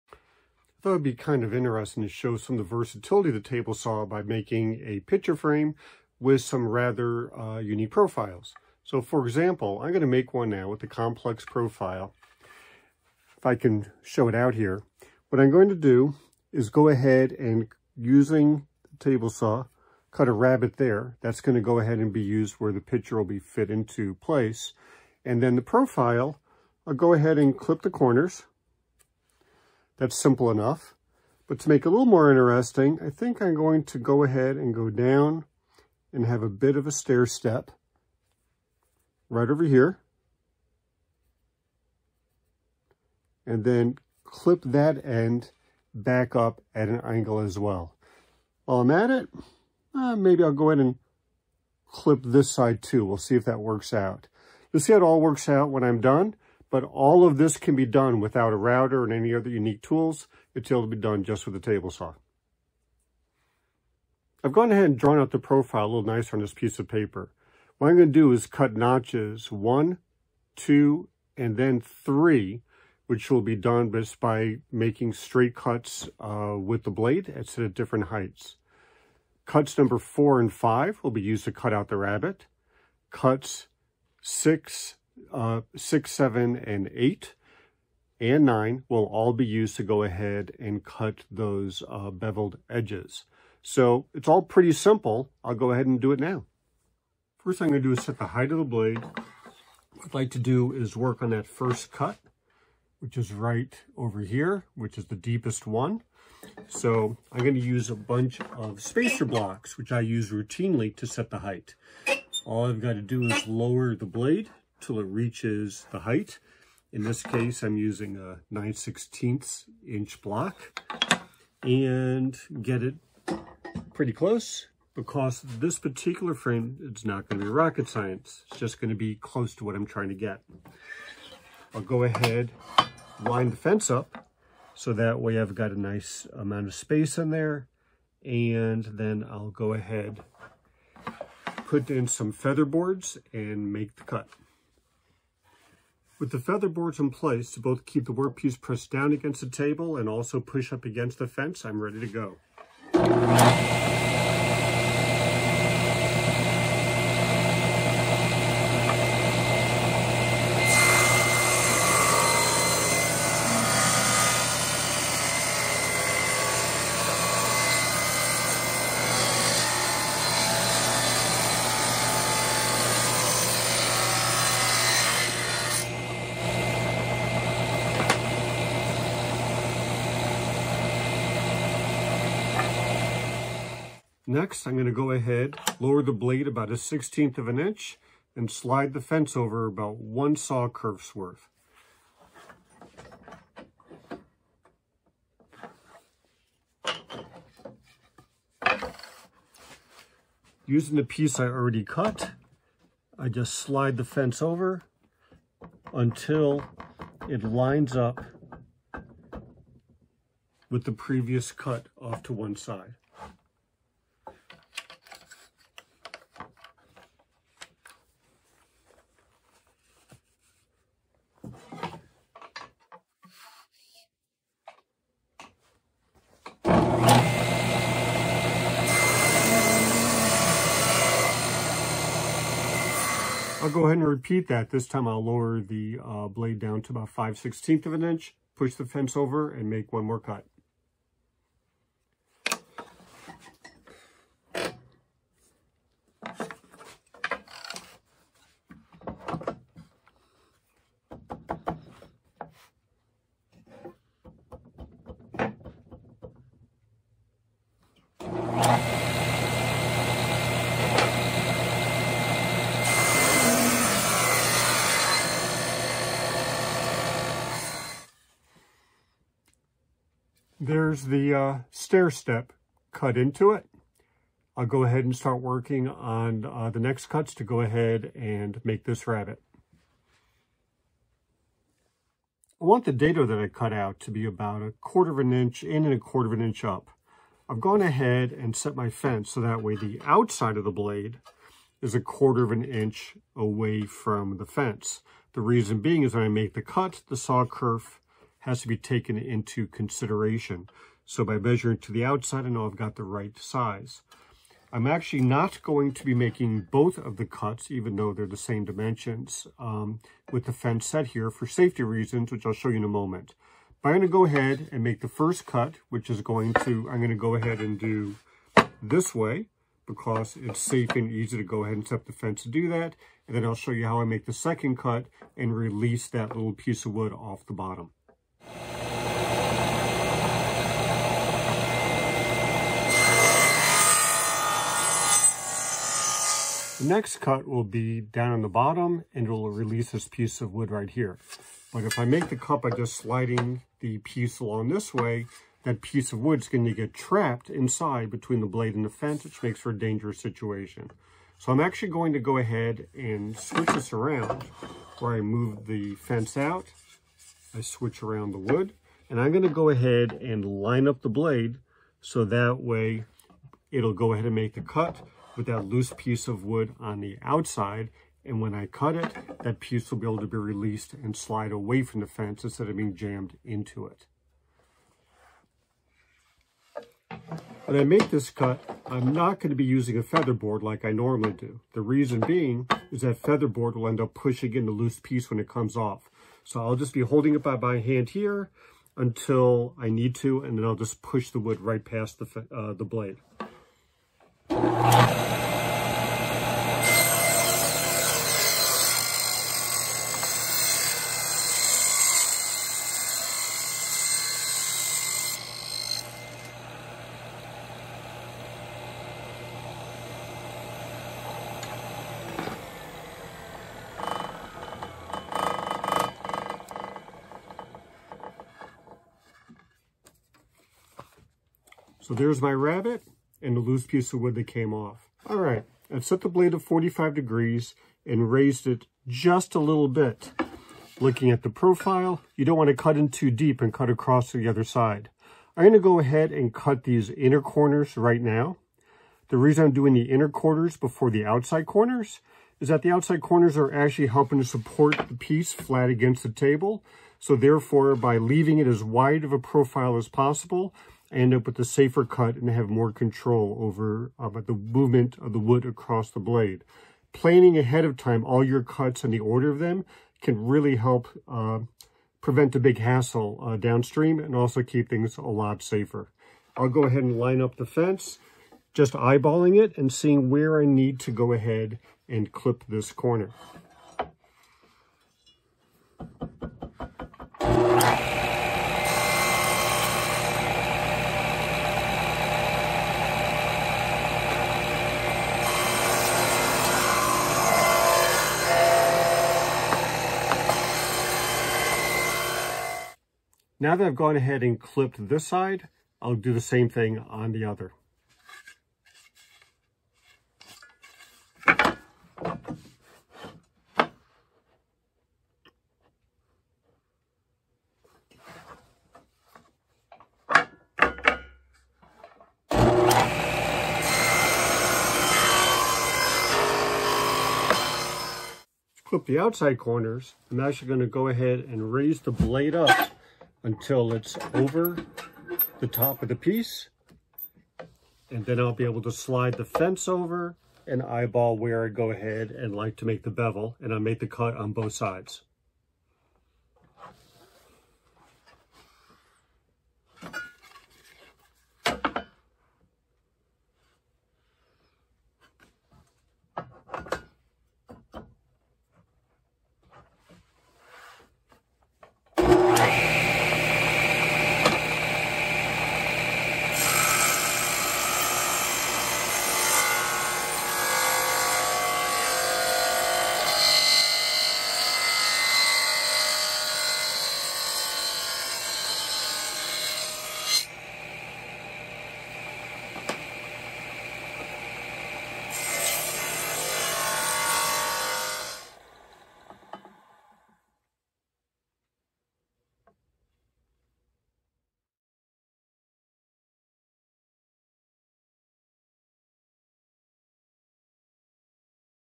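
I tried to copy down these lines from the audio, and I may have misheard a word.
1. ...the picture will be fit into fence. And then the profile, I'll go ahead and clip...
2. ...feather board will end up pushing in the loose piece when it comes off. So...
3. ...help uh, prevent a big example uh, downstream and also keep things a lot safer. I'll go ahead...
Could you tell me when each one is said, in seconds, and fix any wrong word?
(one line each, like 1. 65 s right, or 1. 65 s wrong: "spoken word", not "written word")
1. 22 s wrong: "place", not "fence"
2. 383 s right
3. 460 s wrong: "hassle", not "example".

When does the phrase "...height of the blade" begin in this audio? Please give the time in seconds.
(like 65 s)
98 s.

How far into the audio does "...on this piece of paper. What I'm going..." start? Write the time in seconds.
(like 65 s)
66 s.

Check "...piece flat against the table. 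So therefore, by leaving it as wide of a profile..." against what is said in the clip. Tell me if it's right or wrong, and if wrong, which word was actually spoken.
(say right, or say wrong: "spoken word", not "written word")
right.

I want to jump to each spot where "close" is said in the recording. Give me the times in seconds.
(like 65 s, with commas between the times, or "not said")
124 s, 129 s.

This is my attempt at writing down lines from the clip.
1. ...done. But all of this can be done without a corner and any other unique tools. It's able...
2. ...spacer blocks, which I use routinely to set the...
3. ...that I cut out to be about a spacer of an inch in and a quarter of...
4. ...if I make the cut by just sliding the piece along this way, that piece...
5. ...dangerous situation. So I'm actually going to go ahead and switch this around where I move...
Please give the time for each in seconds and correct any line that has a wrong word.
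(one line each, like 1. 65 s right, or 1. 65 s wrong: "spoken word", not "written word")
1. 56 s wrong: "router", not "corner"
2. 108 s right
3. 283 s wrong: "quarter", not "spacer"
4. 341 s right
5. 349 s right.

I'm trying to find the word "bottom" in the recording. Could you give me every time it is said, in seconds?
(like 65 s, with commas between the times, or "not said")
327 s, 338 s.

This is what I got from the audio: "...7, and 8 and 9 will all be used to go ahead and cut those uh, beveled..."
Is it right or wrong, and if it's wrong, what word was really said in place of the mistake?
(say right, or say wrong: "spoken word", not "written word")
right.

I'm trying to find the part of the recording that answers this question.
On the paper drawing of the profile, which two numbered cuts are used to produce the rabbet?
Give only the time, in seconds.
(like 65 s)
79 s.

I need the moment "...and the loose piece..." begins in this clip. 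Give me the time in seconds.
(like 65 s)
423 s.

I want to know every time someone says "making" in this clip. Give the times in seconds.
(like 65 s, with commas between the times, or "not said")
4 s, 74 s, 306 s.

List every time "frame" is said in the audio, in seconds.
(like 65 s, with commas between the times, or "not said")
5 s, 126 s.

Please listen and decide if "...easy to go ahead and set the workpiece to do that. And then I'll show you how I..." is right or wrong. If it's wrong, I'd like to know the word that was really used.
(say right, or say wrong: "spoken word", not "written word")
wrong: "fence", not "workpiece".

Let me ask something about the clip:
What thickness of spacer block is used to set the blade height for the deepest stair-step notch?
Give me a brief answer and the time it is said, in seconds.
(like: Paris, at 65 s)
9/16 inch, at 118 s.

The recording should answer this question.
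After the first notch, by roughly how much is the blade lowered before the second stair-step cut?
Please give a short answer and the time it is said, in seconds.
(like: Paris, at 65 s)
1/16 inch, at 186 s.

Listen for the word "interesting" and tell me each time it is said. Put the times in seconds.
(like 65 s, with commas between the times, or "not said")
1 s, 32 s.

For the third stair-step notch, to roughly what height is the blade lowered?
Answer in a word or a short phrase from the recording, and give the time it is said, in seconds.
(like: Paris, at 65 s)
5/16 inch, at 237 s.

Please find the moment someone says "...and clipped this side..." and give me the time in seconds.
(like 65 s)
494 s.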